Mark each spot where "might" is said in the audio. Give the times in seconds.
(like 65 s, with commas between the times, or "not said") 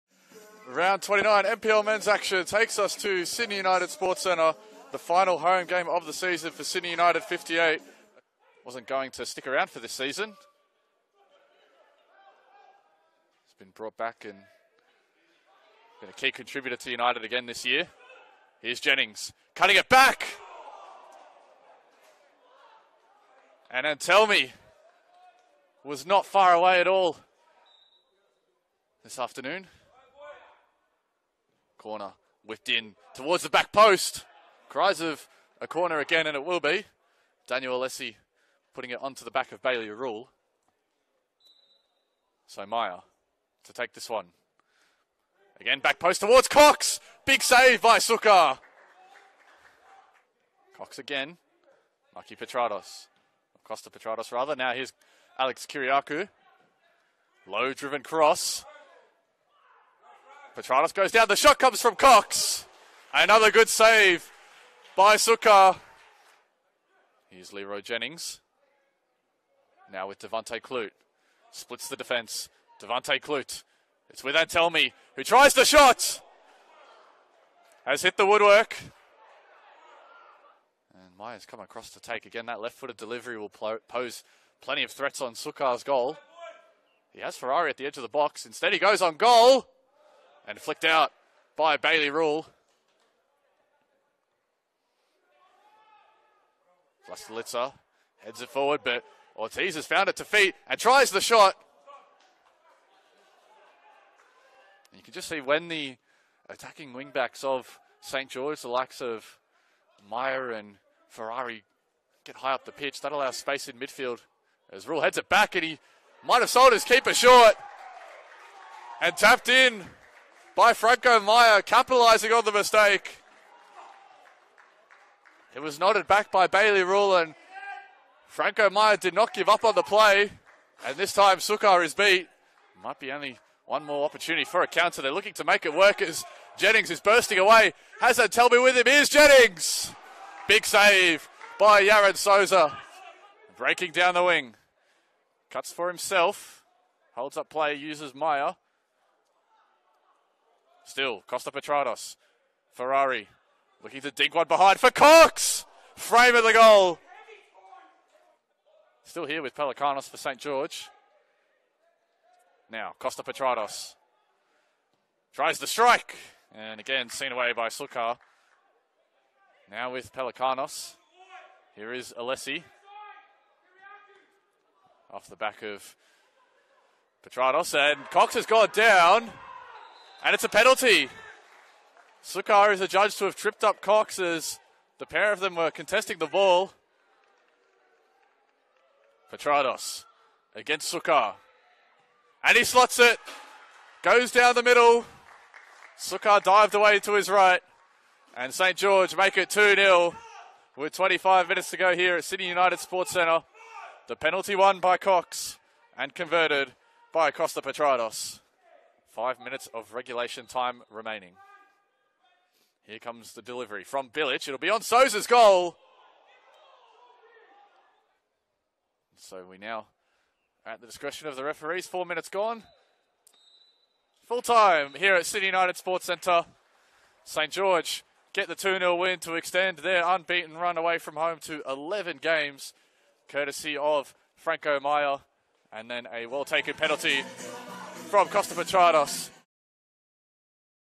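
116 s, 132 s.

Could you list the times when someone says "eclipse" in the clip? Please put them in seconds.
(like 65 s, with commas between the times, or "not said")
not said.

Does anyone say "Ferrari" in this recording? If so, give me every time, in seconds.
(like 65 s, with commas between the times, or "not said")
87 s, 111 s, 152 s.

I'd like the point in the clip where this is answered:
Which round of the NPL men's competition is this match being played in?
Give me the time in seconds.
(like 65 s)
0 s.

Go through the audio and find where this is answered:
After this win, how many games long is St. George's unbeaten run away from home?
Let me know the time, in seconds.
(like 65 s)
231 s.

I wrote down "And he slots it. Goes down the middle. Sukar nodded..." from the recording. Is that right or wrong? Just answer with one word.
wrong.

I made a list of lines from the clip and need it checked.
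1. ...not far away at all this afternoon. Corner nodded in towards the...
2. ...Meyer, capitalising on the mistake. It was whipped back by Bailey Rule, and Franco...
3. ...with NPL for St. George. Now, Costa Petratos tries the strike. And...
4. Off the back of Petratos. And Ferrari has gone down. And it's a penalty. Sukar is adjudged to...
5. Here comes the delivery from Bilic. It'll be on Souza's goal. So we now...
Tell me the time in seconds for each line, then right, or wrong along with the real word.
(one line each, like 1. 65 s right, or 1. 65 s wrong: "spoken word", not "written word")
1. 26 s wrong: "whipped", not "nodded"
2. 121 s wrong: "nodded", not "whipped"
3. 159 s wrong: "Pelicanos", not "NPL"
4. 175 s wrong: "Cox", not "Ferrari"
5. 212 s right.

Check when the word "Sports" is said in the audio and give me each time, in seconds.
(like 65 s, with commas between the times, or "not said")
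3 s, 202 s, 225 s.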